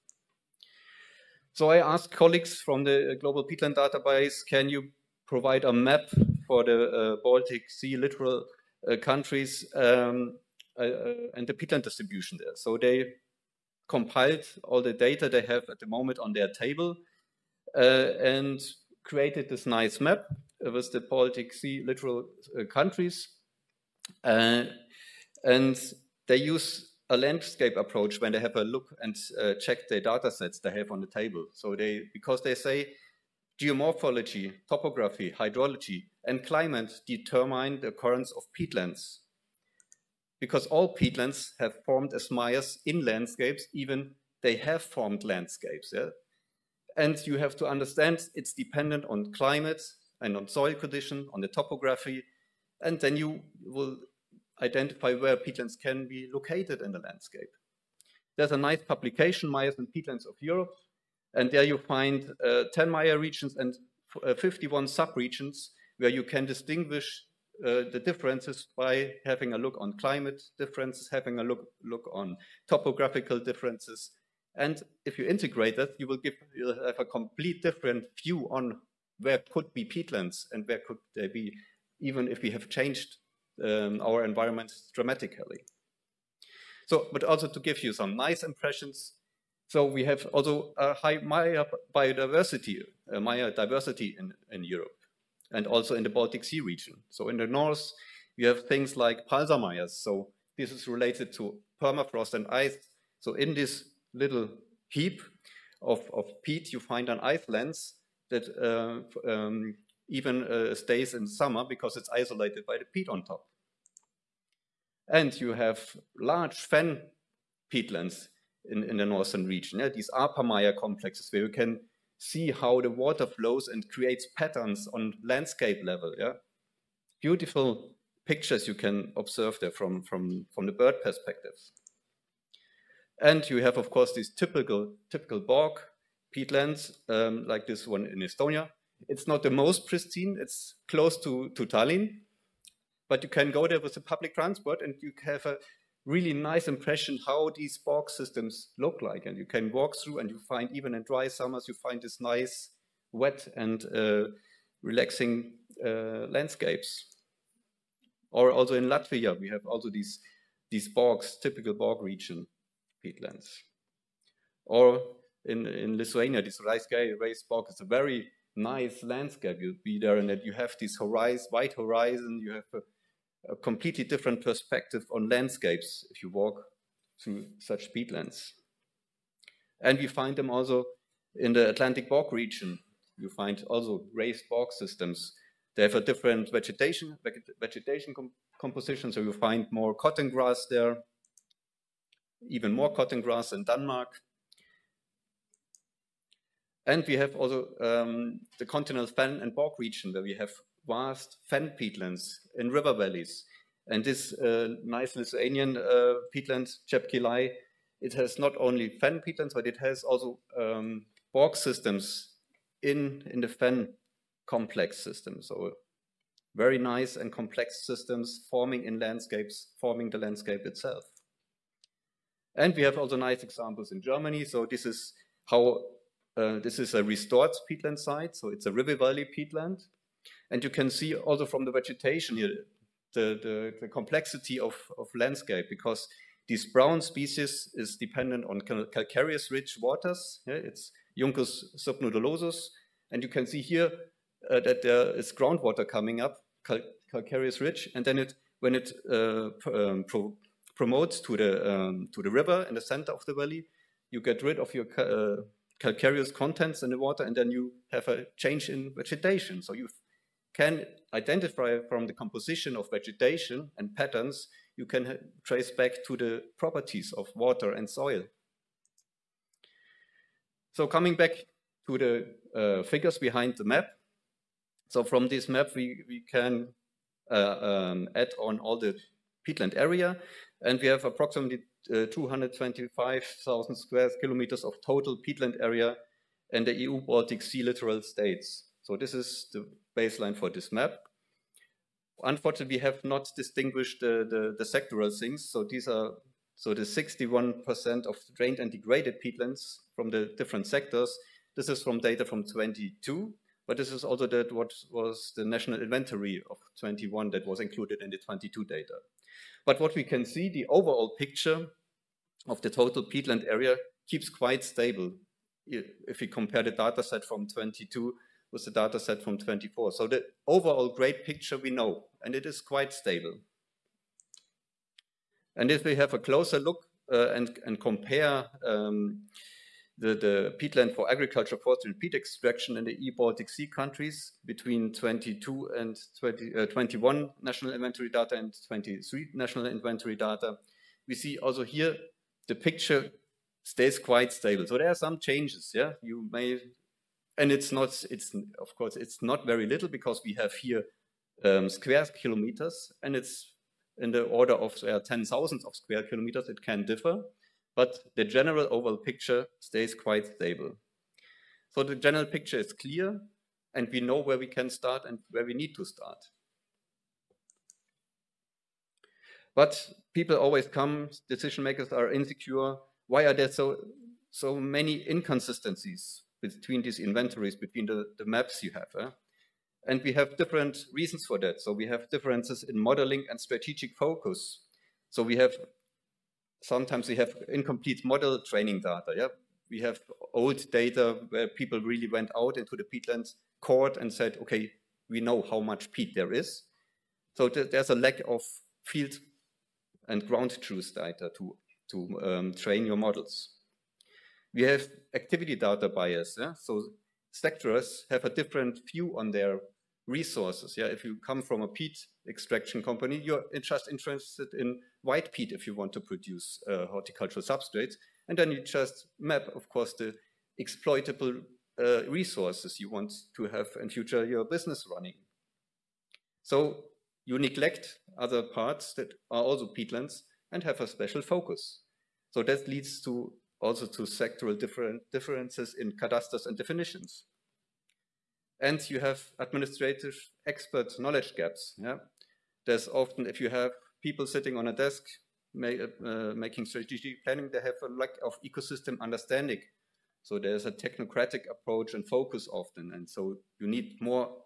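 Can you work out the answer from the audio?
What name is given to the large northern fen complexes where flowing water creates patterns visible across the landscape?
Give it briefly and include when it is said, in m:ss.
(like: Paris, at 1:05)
Aapa mire complexes, at 2:00.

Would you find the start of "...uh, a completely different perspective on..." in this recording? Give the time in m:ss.
2:52.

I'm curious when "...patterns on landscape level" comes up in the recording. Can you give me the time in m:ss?
2:04.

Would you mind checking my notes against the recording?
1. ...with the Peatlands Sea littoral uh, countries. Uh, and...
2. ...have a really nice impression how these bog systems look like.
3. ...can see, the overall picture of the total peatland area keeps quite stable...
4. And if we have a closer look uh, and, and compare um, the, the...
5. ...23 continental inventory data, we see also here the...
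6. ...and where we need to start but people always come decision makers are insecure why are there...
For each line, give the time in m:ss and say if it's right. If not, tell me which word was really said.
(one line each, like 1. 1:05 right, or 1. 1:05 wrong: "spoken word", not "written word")
1. 0:20 wrong: "Baltic", not "Peatlands"
2. 2:25 right
3. 5:10 right
4. 5:25 right
5. 5:38 wrong: "national", not "continental"
6. 6:05 right.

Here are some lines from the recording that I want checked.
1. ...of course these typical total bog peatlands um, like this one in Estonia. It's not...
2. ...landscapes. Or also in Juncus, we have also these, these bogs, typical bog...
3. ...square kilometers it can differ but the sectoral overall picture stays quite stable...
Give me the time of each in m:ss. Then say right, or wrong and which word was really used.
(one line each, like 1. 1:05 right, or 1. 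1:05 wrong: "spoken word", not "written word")
1. 2:13 wrong: "typical", not "total"
2. 2:36 wrong: "Latvia", not "Juncus"
3. 5:55 wrong: "general", not "sectoral".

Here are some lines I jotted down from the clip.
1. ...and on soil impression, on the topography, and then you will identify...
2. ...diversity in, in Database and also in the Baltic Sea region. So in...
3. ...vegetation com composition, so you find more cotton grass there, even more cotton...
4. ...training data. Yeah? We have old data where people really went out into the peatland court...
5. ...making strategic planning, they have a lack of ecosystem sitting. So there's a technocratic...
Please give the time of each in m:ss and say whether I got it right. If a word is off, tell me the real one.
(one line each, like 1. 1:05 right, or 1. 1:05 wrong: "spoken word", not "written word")
1. 0:50 wrong: "condition", not "impression"
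2. 1:33 wrong: "Europe", not "Database"
3. 3:07 right
4. 6:28 right
5. 7:26 wrong: "understanding", not "sitting".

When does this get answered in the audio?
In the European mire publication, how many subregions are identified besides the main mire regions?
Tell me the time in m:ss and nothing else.
1:04.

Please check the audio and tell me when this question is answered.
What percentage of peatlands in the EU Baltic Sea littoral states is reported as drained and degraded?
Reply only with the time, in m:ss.
4:56.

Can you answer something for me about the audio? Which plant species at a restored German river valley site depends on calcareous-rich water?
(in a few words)
Juncus subnodulosus.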